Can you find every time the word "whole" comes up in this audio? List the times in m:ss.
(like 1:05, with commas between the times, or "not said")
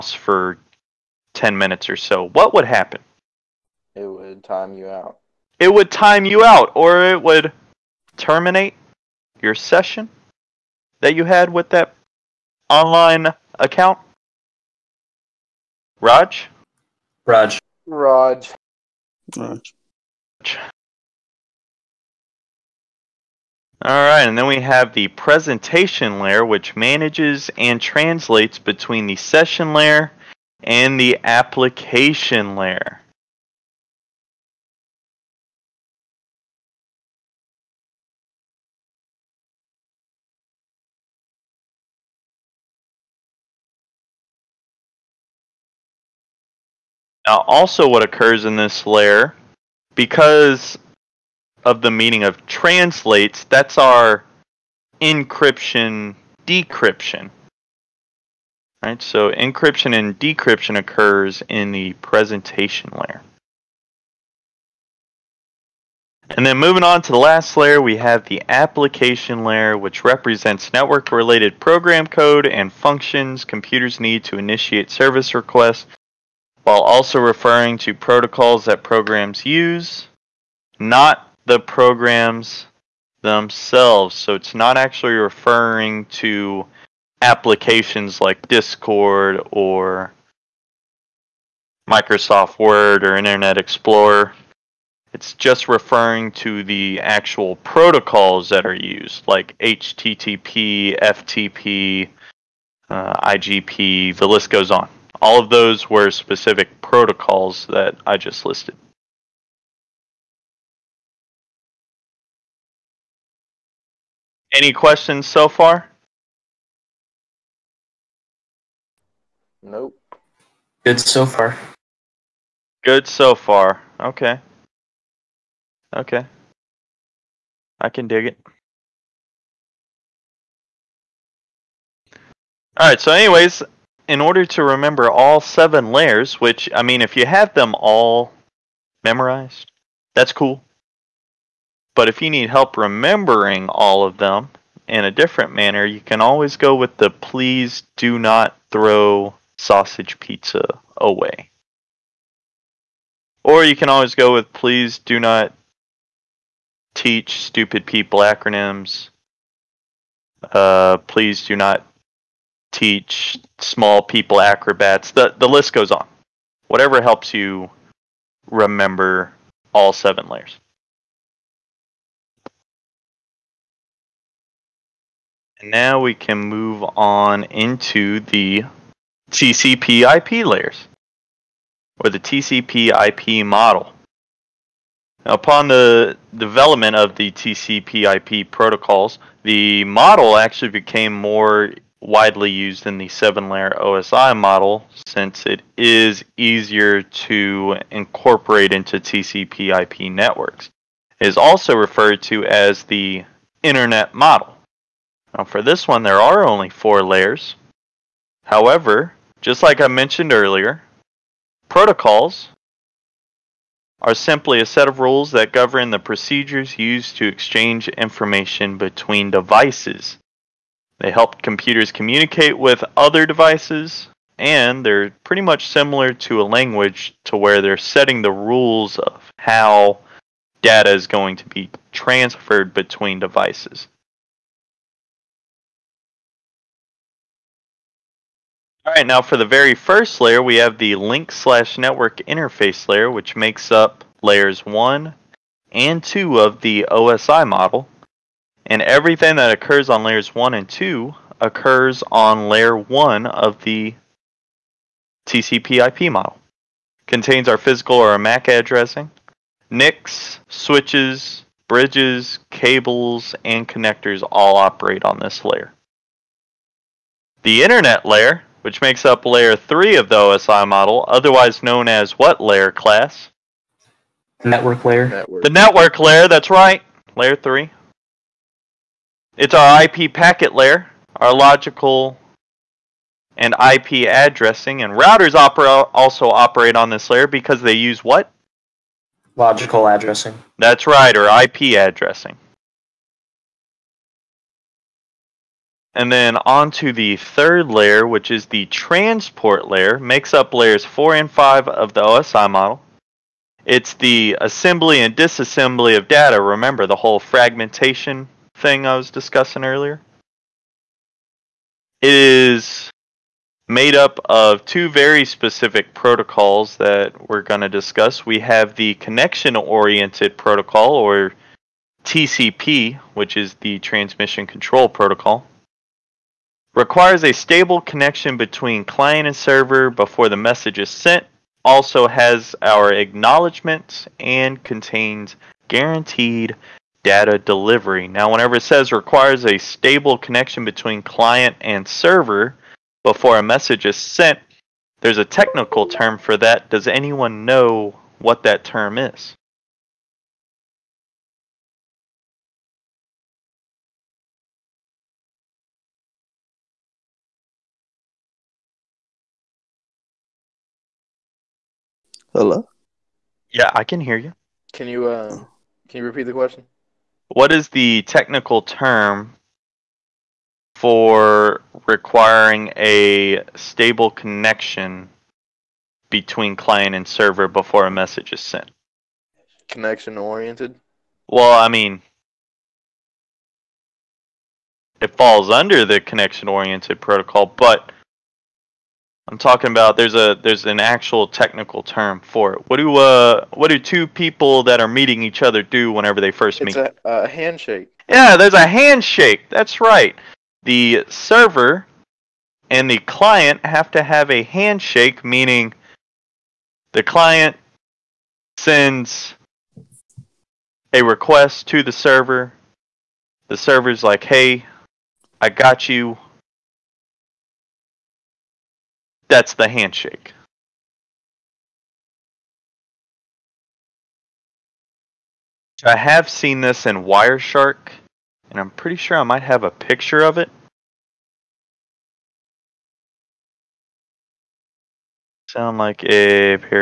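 5:06.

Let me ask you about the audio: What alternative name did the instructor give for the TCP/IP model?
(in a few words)
Internet model.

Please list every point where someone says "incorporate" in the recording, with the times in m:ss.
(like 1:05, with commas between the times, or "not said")
3:17.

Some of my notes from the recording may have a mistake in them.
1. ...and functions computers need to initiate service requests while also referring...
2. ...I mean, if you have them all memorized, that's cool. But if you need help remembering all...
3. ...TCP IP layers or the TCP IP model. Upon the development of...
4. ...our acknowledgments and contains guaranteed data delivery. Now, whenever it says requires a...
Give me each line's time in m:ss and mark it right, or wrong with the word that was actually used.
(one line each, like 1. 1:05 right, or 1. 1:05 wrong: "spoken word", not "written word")
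1. 1:12 right
2. 2:16 right
3. 2:59 right
4. 5:32 right.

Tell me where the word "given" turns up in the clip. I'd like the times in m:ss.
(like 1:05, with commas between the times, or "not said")
not said.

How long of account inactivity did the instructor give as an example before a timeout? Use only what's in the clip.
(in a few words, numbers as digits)
10 minutes.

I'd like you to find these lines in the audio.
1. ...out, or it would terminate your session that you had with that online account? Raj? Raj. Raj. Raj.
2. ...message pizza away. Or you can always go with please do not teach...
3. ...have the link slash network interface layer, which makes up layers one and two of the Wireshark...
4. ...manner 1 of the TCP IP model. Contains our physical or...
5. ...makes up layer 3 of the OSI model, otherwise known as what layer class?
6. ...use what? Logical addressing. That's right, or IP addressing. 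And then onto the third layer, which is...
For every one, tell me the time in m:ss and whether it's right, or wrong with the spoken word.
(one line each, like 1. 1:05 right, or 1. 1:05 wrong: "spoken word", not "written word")
1. 0:06 right
2. 2:29 wrong: "sausage", not "message"
3. 4:00 wrong: "OSI", not "Wireshark"
4. 4:12 wrong: "layer", not "manner"
5. 4:28 right
6. 4:47 right.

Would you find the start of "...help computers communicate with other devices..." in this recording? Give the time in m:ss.
3:41.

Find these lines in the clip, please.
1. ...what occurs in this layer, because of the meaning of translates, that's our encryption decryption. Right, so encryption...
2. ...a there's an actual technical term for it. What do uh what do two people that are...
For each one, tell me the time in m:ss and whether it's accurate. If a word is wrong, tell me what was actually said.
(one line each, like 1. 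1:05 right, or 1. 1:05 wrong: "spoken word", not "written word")
1. 0:47 right
2. 6:30 right.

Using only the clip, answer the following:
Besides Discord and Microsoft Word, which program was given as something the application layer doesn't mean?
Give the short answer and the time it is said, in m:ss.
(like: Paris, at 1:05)
Internet Explorer, at 1:33.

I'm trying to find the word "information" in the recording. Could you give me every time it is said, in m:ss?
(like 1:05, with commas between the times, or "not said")
3:37.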